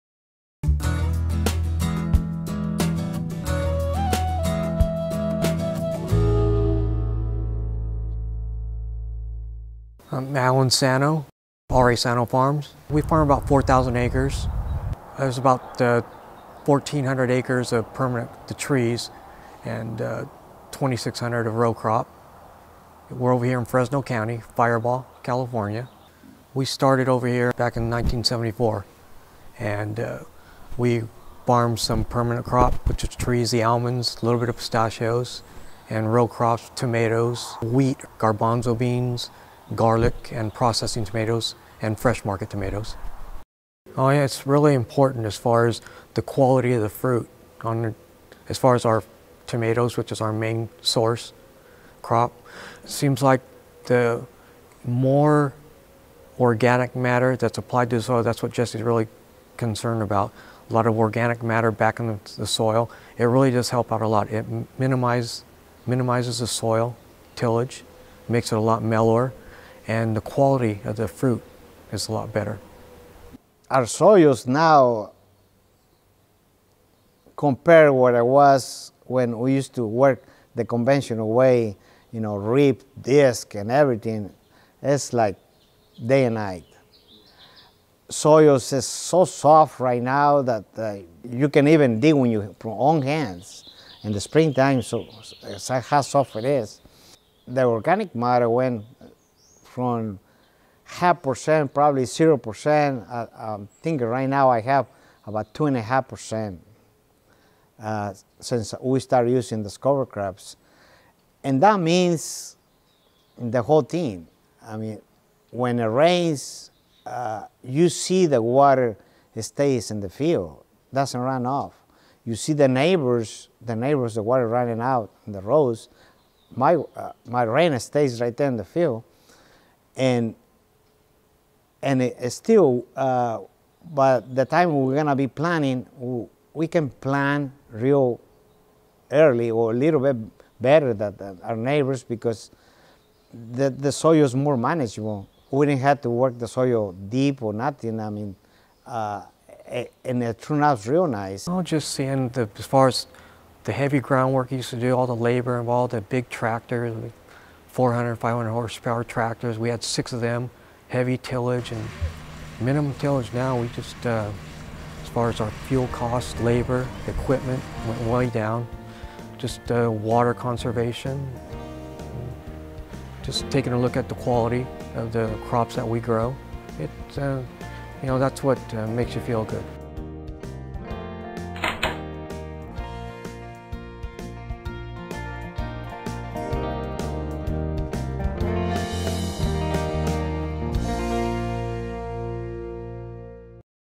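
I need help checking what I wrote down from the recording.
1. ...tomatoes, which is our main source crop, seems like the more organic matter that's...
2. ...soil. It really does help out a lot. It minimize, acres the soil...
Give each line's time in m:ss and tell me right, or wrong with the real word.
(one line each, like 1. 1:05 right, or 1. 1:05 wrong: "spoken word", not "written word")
1. 0:49 right
2. 1:02 wrong: "minimizes", not "acres".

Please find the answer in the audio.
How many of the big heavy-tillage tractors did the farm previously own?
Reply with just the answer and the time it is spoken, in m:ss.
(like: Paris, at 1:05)
6, at 2:39.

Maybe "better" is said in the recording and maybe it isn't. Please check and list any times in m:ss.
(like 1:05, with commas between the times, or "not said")
1:12, 2:20.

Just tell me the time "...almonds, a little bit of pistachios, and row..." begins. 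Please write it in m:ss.
0:33.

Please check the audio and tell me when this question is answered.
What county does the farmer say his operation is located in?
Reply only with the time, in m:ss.
0:23.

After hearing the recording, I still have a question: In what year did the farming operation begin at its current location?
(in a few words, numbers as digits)
1974.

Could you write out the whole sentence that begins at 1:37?
The organic matter, when from half percent, probably zero percent.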